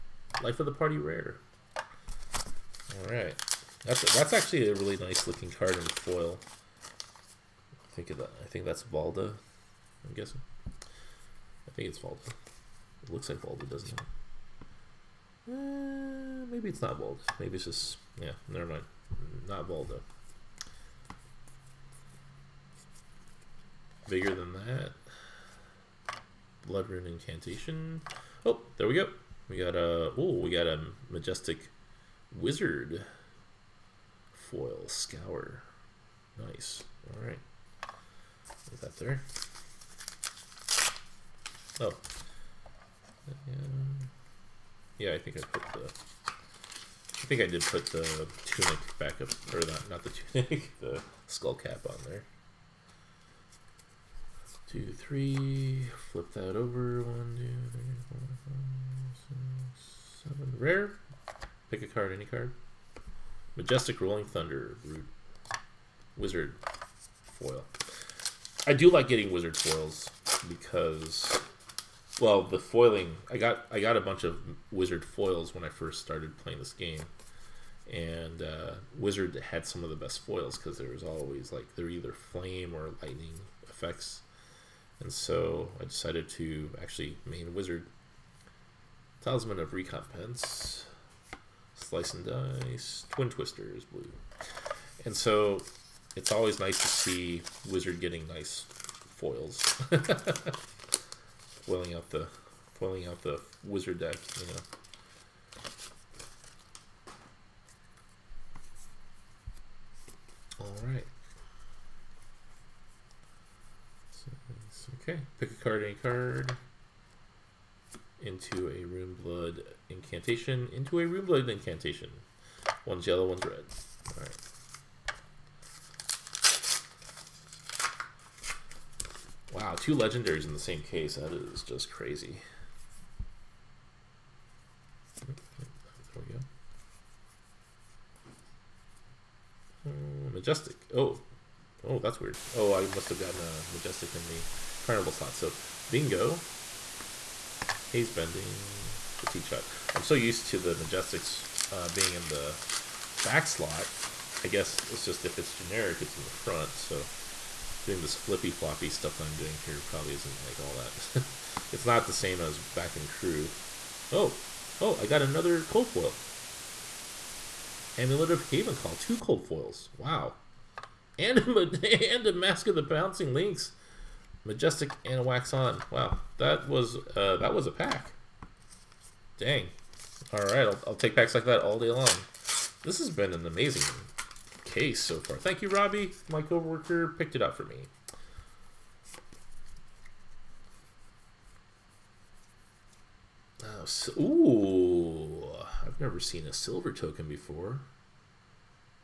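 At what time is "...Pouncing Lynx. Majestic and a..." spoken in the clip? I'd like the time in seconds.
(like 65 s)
172 s.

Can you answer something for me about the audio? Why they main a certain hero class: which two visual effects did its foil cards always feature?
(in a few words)
Flame or lightning.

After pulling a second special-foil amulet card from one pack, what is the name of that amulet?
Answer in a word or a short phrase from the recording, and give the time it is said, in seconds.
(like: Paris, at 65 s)
Amulet of Haven Call, at 167 s.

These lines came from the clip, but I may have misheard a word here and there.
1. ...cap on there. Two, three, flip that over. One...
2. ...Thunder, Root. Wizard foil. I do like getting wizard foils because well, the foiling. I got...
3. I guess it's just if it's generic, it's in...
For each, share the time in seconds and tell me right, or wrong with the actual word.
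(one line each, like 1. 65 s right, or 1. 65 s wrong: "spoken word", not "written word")
1. 51 s right
2. 64 s right
3. 154 s right.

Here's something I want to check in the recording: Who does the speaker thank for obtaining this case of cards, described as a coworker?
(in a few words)
Robbie.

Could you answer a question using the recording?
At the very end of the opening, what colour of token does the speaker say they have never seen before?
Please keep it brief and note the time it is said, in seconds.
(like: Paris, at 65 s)
Silver, at 196 s.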